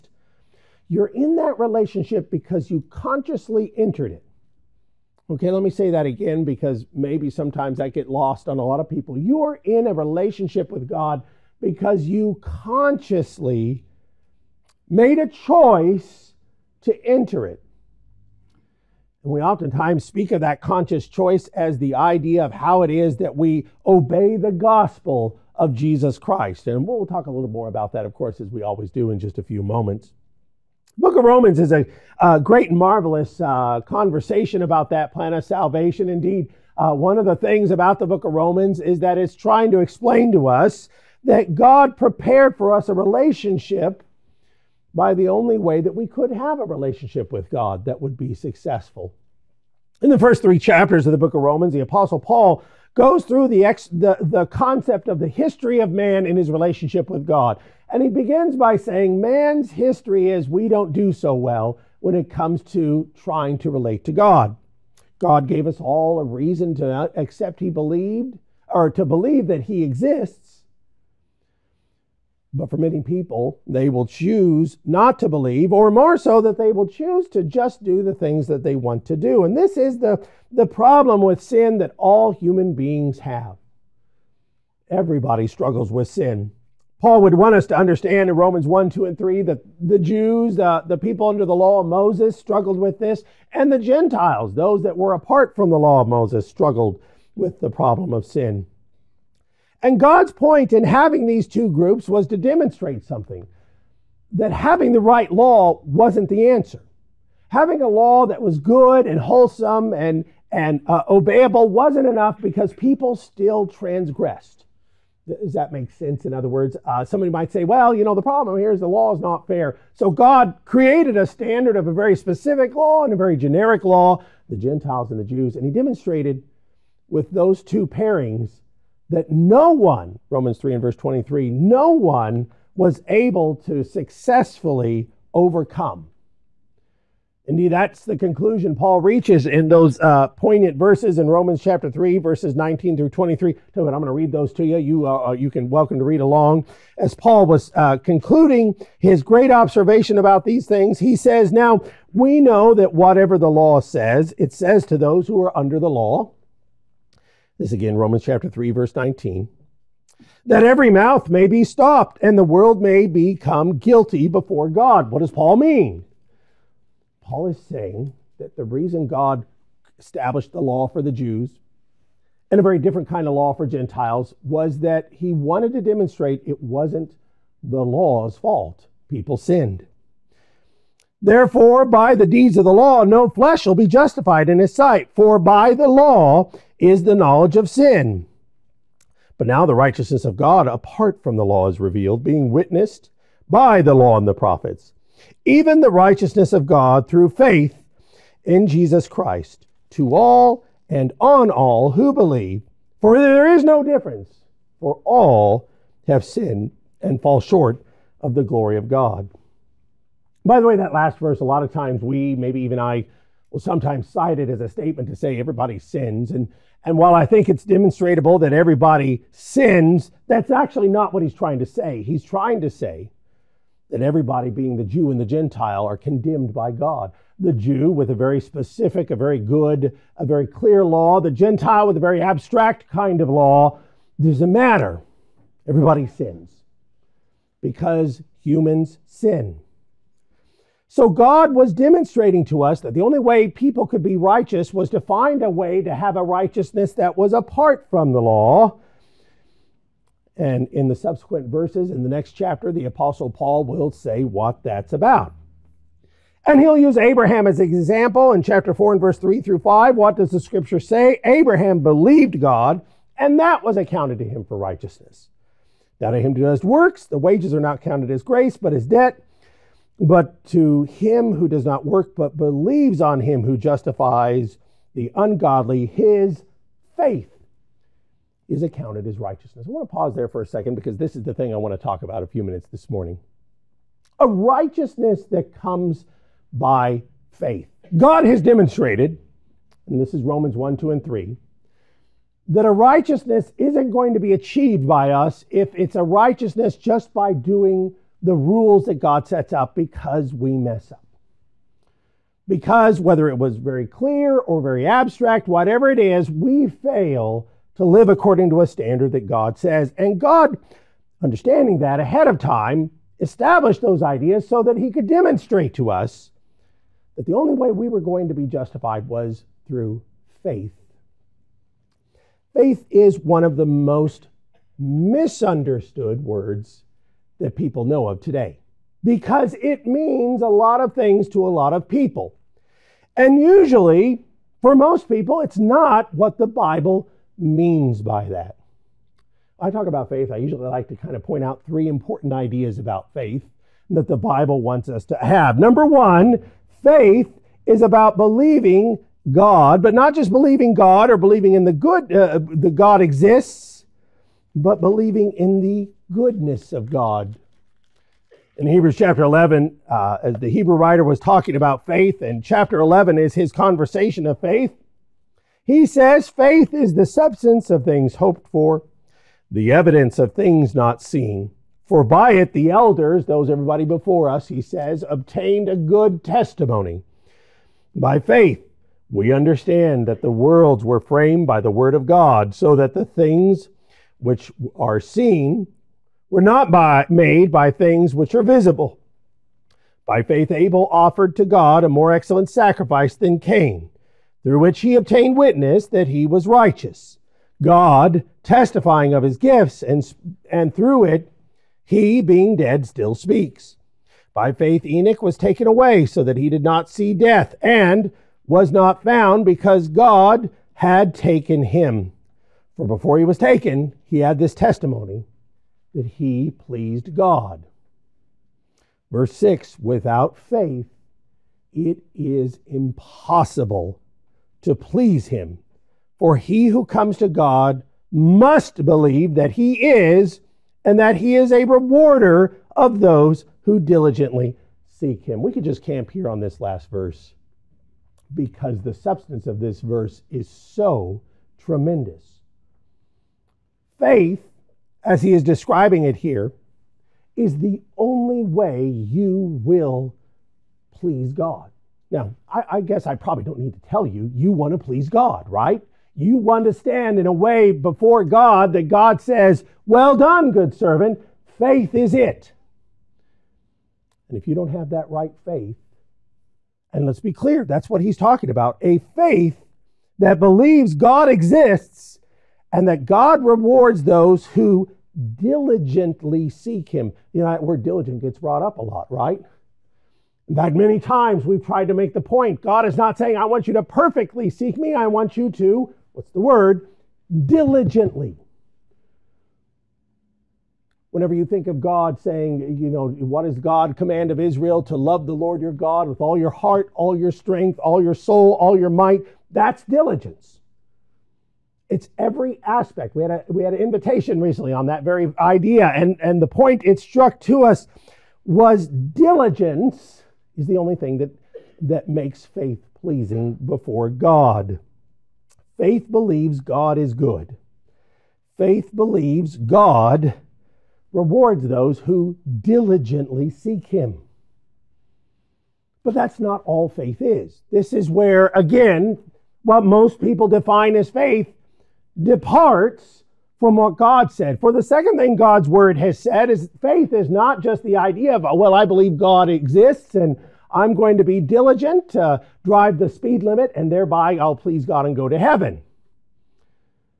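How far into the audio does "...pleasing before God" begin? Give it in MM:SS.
08:33.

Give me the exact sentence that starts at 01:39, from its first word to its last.
And God's point in having these two groups was to demonstrate something that having the right law wasn't the answer.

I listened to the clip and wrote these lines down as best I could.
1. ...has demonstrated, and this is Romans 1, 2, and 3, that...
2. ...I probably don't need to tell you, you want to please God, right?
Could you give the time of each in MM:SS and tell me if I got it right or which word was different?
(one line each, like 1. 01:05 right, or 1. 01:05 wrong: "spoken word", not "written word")
1. 04:48 right
2. 07:33 right.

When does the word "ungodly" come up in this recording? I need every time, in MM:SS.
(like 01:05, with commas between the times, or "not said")
04:35.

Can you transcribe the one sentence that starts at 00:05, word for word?
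Okay, let me say that again because maybe sometimes I get lost on a lot of people.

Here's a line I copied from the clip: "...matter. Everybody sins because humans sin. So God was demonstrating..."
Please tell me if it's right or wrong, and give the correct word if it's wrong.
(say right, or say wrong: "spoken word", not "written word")
right.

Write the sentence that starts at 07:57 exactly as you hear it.
You know, that word diligent gets brought up a lot, right?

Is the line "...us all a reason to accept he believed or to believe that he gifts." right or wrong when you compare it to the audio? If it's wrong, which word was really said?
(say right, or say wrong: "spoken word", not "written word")
wrong: "exists", not "gifts".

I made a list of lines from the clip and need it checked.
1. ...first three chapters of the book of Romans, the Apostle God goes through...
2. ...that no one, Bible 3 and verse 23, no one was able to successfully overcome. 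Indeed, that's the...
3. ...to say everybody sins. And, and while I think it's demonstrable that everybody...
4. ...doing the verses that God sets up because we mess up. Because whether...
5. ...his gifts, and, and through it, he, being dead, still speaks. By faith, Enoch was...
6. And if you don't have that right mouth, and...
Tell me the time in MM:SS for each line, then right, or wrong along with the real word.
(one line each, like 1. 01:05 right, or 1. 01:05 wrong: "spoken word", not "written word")
1. 00:50 wrong: "Paul", not "God"
2. 02:09 wrong: "Romans", not "Bible"
3. 03:35 right
4. 04:57 wrong: "rules", not "verses"
5. 06:39 right
6. 07:44 wrong: "faith", not "mouth".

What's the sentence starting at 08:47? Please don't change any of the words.
This is where, again, what most people define as faith departs from what God said.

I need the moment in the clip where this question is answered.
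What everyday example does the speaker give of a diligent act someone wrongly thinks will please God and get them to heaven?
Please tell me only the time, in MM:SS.
09:02.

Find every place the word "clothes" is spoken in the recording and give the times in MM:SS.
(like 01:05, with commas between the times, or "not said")
not said.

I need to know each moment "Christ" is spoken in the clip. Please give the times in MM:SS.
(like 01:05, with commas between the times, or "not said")
00:26, 03:19.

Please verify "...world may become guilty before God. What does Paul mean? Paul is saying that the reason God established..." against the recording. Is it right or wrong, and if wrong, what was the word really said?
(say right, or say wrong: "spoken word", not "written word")
right.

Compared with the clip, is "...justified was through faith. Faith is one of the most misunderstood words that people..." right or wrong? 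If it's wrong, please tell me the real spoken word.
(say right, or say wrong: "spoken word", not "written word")
right.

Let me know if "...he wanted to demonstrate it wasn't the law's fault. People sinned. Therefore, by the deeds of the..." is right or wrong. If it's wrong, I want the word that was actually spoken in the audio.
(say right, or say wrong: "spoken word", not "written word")
right.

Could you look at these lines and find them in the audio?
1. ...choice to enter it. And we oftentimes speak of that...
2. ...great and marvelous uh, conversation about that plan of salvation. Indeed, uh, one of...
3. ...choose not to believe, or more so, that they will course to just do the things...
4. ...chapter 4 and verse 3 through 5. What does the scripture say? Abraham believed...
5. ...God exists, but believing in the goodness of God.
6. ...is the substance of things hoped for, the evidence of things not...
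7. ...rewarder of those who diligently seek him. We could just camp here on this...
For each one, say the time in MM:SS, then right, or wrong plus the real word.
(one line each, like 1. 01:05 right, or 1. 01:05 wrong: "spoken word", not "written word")
1. 00:15 right
2. 00:32 right
3. 01:14 wrong: "choose", not "course"
4. 04:18 right
5. 05:52 right
6. 06:06 right
7. 07:11 right.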